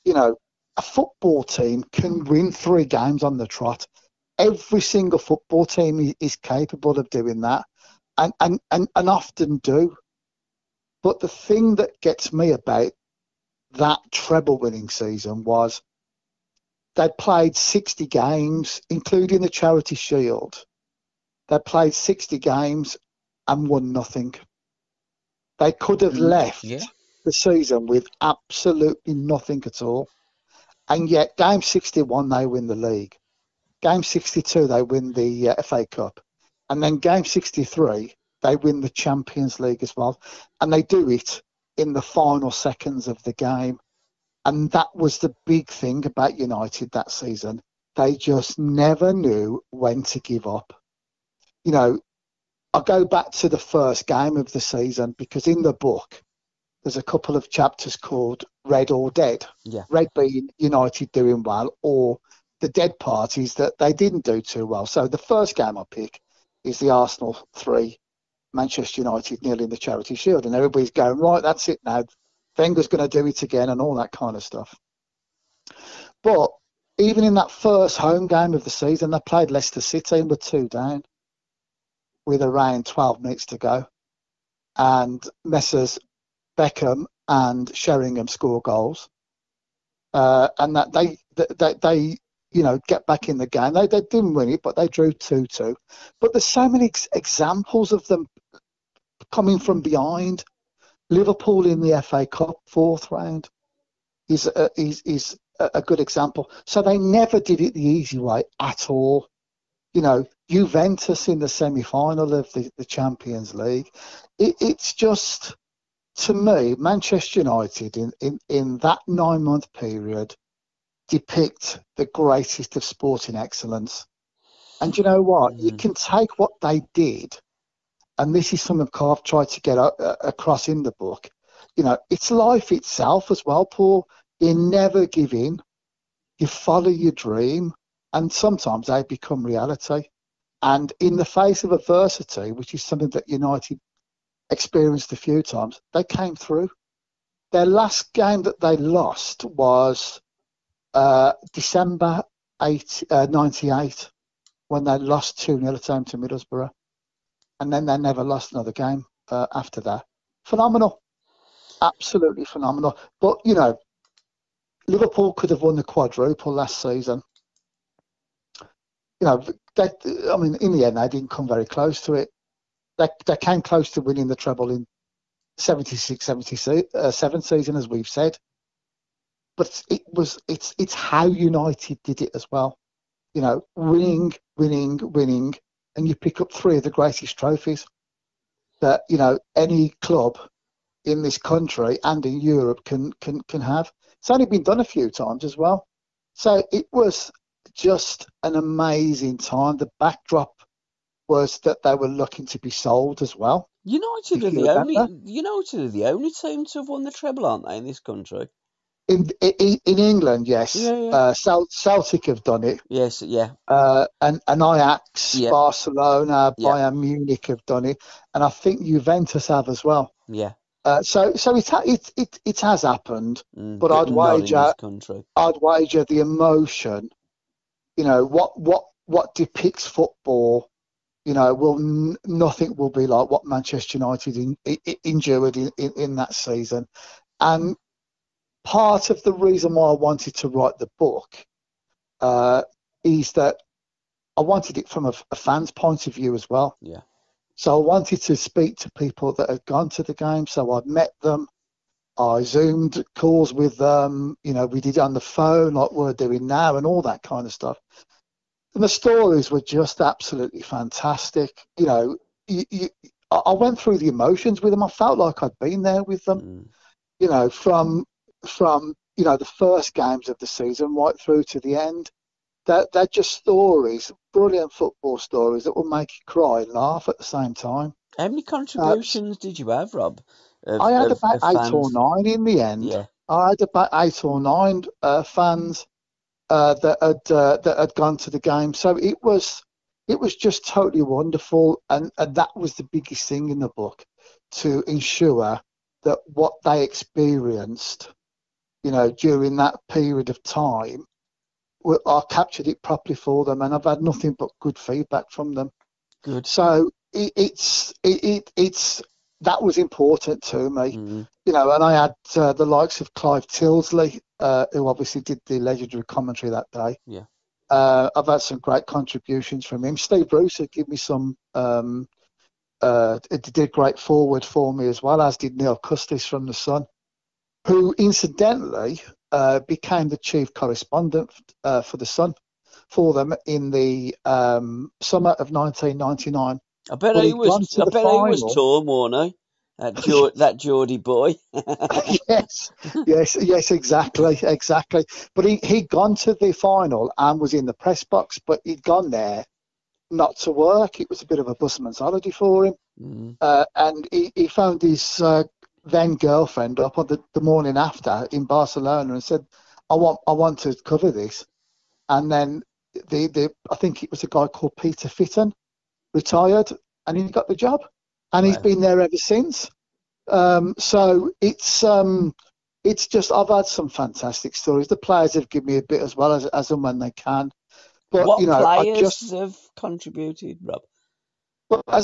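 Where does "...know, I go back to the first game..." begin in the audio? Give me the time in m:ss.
0:51.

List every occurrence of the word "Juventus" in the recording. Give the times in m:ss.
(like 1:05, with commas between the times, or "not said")
1:50, 3:38.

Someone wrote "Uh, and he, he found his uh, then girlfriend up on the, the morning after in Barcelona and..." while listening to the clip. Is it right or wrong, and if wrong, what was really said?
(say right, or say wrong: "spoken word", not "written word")
right.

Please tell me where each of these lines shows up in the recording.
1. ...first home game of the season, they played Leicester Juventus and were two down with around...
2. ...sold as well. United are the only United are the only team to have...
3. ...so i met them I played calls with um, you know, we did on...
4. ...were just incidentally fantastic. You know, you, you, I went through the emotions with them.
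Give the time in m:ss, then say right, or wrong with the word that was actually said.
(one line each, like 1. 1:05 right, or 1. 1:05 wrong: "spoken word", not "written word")
1. 1:17 wrong: "City", not "Juventus"
2. 3:22 right
3. 4:10 wrong: "zoomed", not "played"
4. 4:19 wrong: "absolutely", not "incidentally".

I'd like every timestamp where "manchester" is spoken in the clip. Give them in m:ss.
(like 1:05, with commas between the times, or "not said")
1:08, 1:56, 3:53.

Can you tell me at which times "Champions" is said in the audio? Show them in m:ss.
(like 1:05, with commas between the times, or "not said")
0:38, 1:52.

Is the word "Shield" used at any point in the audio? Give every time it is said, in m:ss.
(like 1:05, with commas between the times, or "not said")
0:19, 1:10.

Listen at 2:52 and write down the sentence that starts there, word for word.
They, they came close to winning the treble in 76 77 uh, season, as we've said.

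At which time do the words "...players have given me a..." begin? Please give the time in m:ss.
6:14.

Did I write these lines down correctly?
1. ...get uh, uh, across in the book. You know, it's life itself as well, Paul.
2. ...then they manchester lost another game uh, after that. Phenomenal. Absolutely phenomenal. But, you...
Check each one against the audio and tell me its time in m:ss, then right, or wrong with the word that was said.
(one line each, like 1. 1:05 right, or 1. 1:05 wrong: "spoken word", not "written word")
1. 2:09 right
2. 2:37 wrong: "never", not "manchester".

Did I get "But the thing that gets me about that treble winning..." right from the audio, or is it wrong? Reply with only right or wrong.
right.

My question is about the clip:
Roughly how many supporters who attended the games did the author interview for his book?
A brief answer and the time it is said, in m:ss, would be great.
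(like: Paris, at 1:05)
8 or 9, at 4:43.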